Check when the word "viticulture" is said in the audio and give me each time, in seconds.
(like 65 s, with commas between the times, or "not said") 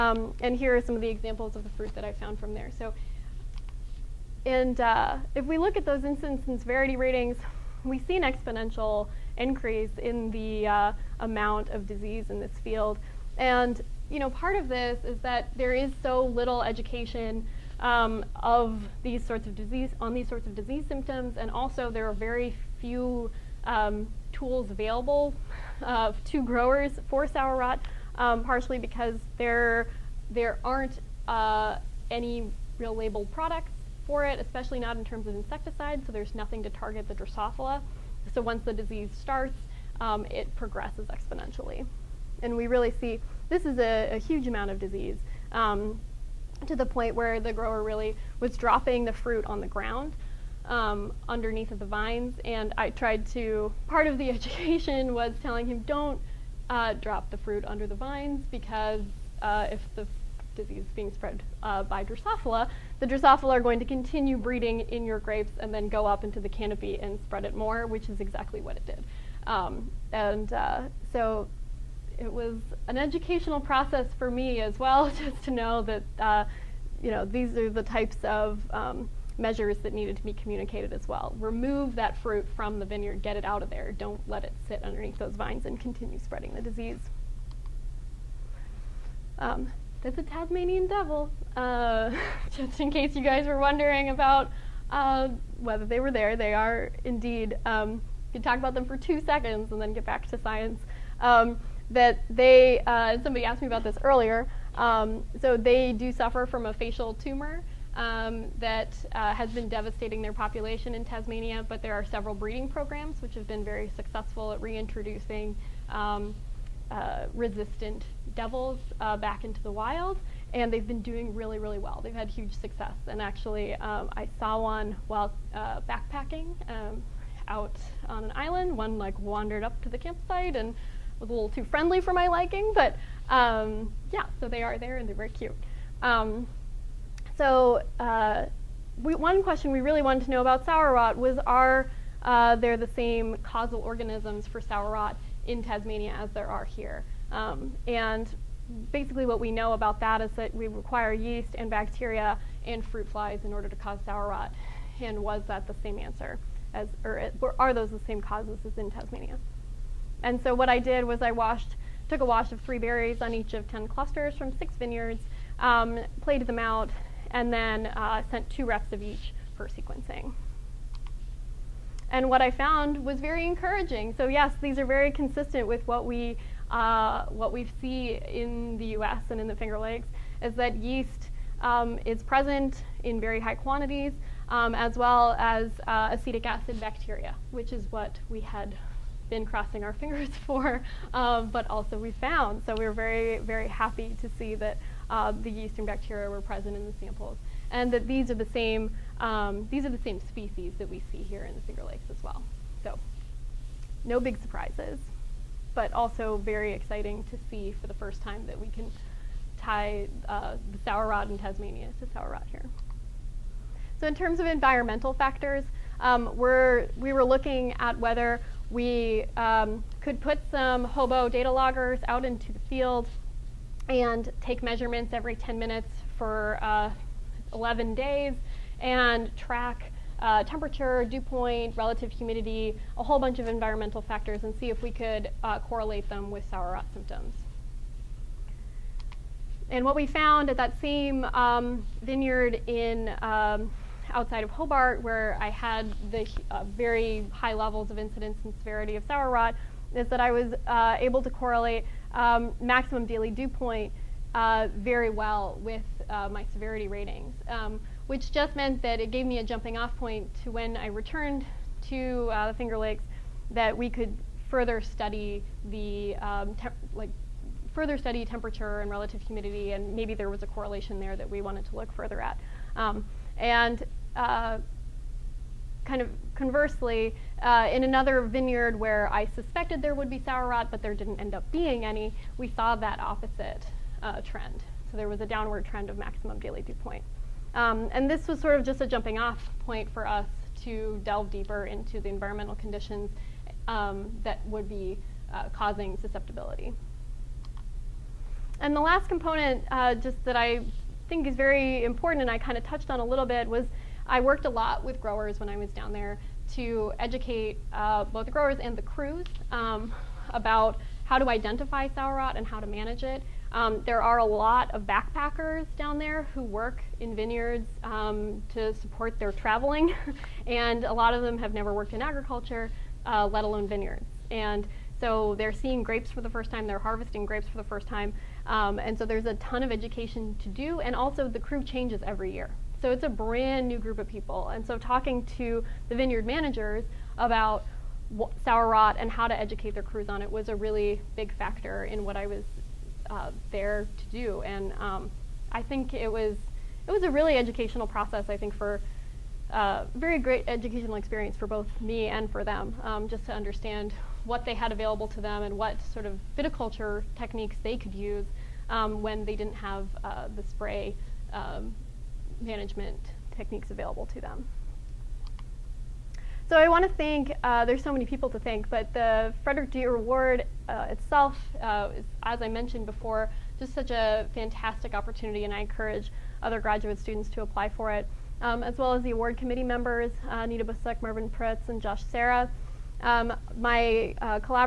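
356 s.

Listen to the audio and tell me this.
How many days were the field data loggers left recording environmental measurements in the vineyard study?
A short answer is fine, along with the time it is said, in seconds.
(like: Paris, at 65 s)
11 days, at 227 s.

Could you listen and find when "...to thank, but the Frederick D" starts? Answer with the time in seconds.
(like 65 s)
368 s.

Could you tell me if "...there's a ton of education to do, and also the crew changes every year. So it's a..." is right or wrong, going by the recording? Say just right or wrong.
right.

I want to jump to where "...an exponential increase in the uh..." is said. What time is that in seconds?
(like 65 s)
8 s.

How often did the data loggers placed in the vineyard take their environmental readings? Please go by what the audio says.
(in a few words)
Every 10 minutes.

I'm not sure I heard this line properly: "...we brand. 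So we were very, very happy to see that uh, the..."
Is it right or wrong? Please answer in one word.
wrong.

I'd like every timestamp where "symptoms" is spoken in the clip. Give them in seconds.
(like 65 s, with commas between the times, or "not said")
20 s, 236 s.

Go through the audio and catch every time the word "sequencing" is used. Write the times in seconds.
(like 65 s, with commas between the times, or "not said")
169 s.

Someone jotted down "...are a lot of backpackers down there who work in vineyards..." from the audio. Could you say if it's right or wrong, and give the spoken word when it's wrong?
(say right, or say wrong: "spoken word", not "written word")
right.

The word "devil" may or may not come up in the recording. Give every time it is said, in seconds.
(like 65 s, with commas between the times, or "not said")
90 s, 118 s.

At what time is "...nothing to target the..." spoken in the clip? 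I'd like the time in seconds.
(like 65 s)
36 s.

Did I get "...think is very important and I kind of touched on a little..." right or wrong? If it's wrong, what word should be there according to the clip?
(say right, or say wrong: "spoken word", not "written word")
right.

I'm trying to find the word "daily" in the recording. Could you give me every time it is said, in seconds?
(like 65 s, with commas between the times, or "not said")
253 s, 286 s.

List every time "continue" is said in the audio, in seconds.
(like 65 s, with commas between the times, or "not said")
63 s, 85 s.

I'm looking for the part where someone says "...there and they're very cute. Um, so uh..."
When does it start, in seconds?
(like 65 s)
134 s.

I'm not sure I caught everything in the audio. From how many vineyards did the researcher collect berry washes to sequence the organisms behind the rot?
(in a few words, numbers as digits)
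6.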